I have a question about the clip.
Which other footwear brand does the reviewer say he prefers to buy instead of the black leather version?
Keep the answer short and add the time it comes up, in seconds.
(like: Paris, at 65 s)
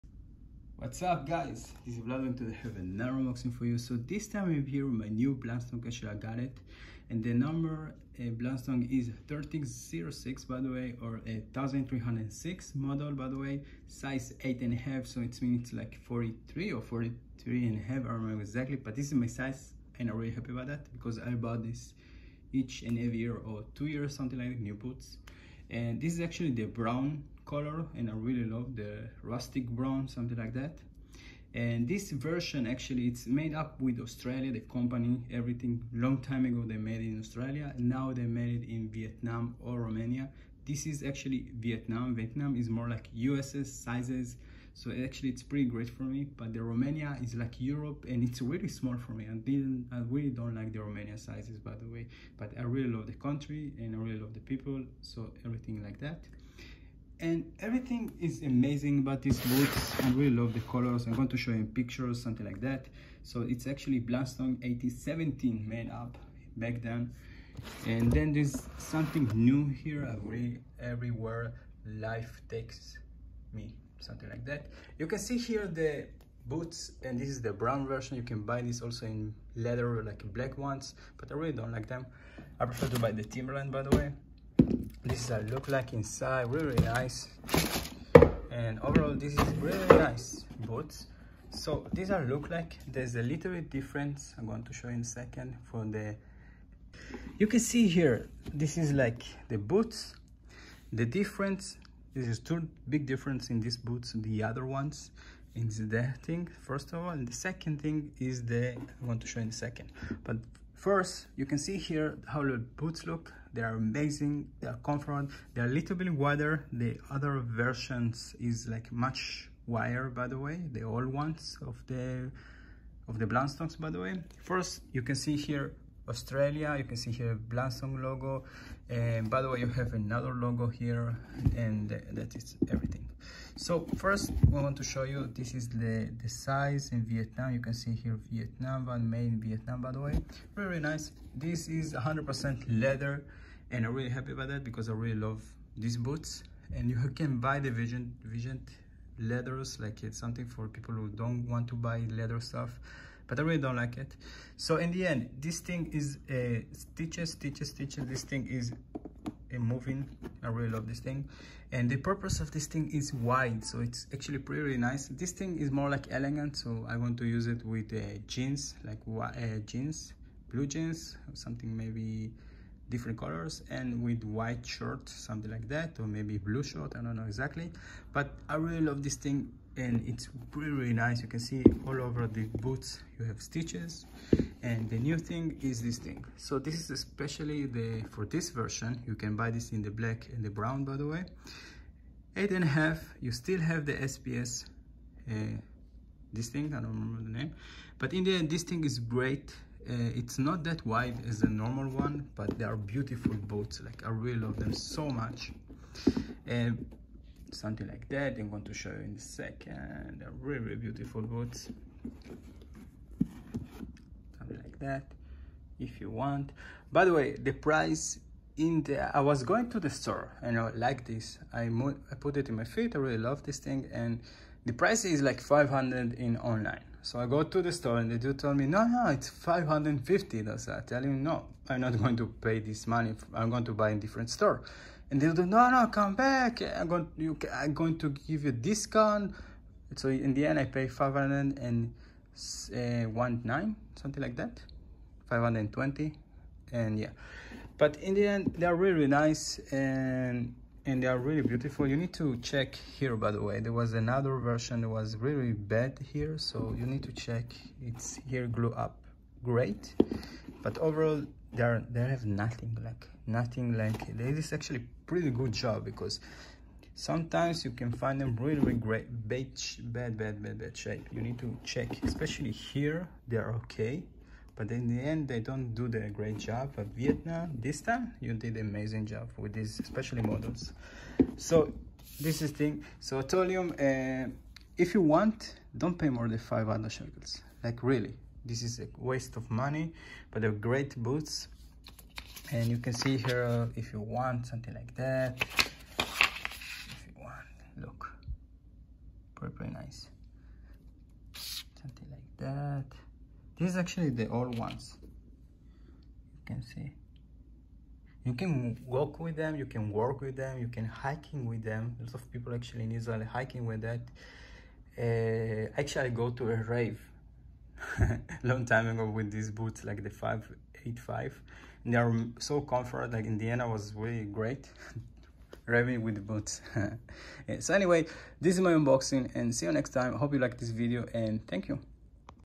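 Timberland, at 83 s.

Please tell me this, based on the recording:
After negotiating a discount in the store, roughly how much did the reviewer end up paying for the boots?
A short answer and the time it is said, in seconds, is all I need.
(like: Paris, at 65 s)
519, at 240 s.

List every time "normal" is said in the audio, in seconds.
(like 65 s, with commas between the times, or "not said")
201 s.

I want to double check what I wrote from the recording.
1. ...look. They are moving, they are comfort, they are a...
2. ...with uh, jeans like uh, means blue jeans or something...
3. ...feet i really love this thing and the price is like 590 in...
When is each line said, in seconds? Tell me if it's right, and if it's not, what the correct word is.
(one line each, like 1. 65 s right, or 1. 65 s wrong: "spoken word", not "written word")
1. 113 s wrong: "amazing", not "moving"
2. 167 s wrong: "jeans", not "means"
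3. 222 s wrong: "500", not "590".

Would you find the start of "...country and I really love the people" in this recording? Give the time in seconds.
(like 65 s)
53 s.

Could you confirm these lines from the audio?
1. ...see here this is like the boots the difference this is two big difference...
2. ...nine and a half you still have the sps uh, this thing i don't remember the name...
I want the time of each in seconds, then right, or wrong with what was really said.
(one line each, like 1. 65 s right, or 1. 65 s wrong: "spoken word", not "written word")
1. 97 s right
2. 192 s wrong: "eight", not "nine".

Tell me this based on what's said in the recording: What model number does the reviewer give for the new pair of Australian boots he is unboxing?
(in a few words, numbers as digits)
1306.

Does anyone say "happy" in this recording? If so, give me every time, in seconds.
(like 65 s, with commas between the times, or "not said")
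20 s, 144 s.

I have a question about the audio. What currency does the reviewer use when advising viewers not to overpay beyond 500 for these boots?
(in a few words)
Shekels.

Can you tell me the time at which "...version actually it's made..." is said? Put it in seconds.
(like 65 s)
32 s.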